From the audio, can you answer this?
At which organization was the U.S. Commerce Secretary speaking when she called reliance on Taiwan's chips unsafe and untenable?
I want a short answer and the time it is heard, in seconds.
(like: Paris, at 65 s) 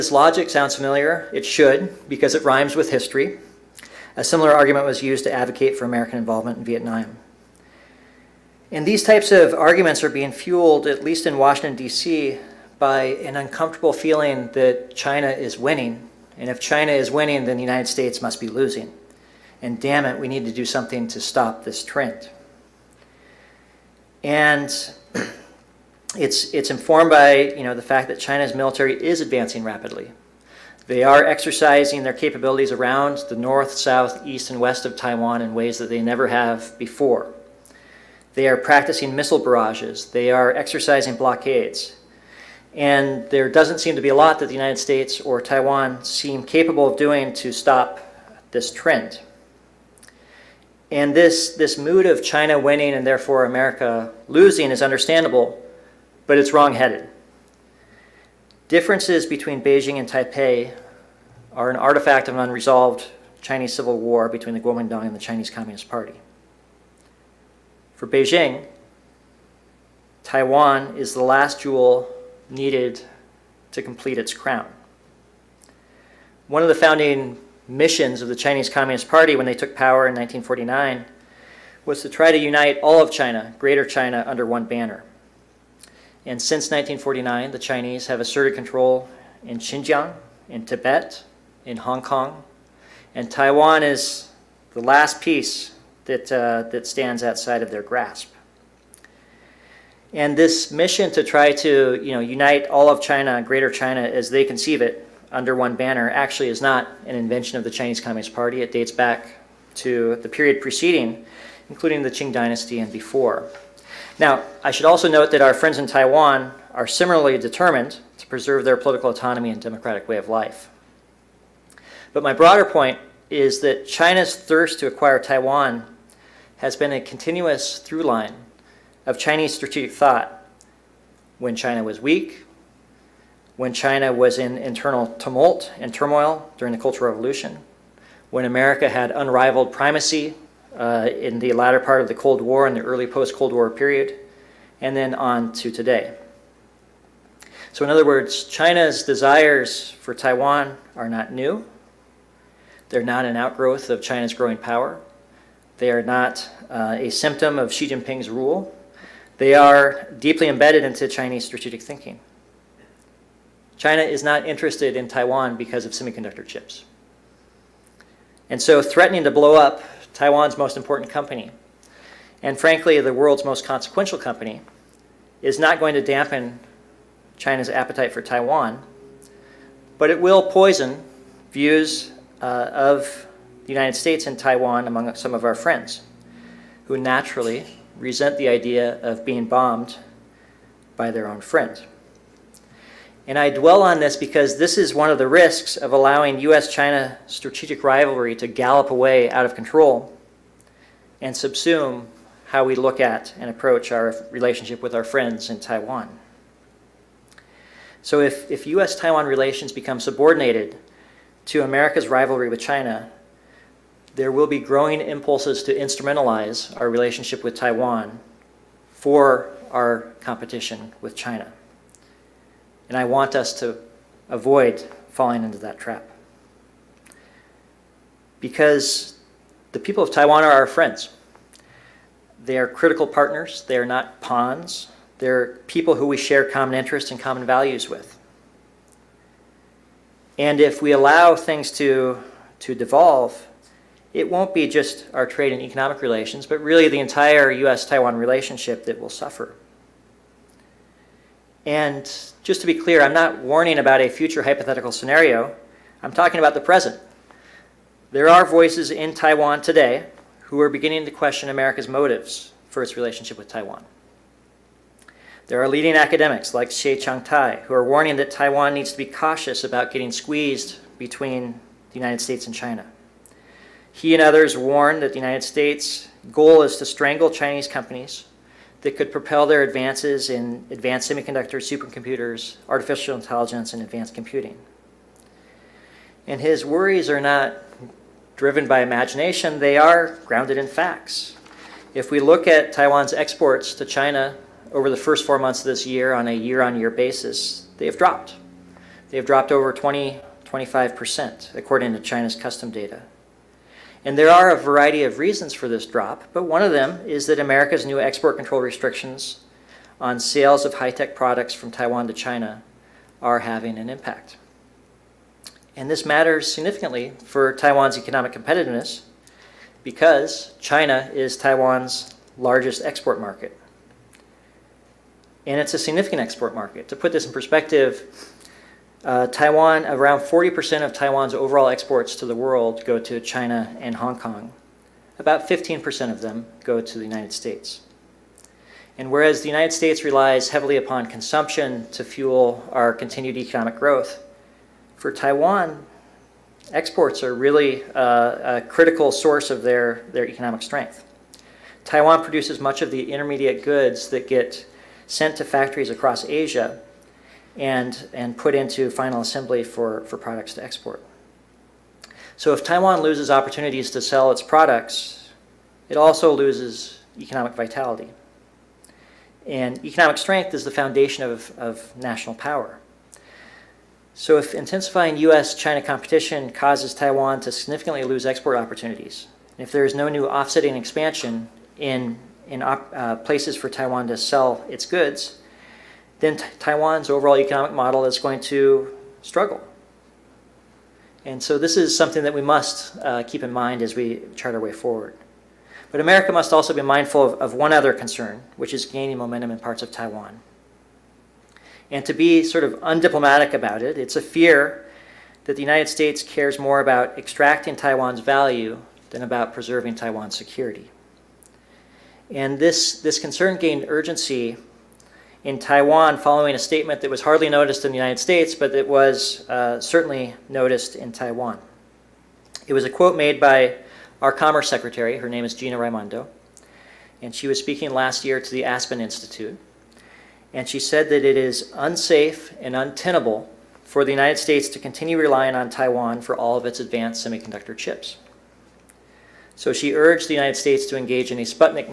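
Aspen Institute, at 428 s.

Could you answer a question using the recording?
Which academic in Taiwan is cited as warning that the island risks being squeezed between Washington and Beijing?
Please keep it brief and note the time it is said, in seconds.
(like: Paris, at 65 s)
Xie Tai, at 266 s.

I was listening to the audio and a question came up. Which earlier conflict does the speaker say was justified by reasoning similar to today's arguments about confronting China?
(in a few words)
Vietnam.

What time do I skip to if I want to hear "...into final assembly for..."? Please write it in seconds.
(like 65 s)
358 s.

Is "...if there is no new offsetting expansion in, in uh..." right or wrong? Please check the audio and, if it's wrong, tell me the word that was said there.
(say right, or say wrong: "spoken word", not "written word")
right.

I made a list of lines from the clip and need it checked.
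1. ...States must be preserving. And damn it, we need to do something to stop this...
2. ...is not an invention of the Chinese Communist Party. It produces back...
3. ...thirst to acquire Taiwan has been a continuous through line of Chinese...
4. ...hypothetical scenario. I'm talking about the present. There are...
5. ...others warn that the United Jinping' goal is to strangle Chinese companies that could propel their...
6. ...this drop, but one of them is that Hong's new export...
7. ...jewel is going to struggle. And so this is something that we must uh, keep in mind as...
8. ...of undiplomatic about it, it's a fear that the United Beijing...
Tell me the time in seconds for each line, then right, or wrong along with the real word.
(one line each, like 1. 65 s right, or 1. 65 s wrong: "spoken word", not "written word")
1. 17 s wrong: "losing", not "preserving"
2. 106 s wrong: "dates", not "produces"
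3. 124 s right
4. 254 s right
5. 274 s wrong: "States", not "Jinping"
6. 305 s wrong: "America", not "Hong"
7. 387 s wrong: "model", not "jewel"
8. 402 s wrong: "States", not "Beijing".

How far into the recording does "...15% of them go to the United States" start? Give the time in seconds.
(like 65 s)
335 s.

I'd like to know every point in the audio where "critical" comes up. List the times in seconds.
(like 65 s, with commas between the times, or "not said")
232 s, 348 s.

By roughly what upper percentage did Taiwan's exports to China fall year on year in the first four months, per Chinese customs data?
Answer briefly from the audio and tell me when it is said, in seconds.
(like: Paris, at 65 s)
25%, at 300 s.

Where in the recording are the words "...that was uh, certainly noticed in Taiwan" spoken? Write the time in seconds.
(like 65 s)
418 s.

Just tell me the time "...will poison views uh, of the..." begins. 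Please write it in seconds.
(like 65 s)
180 s.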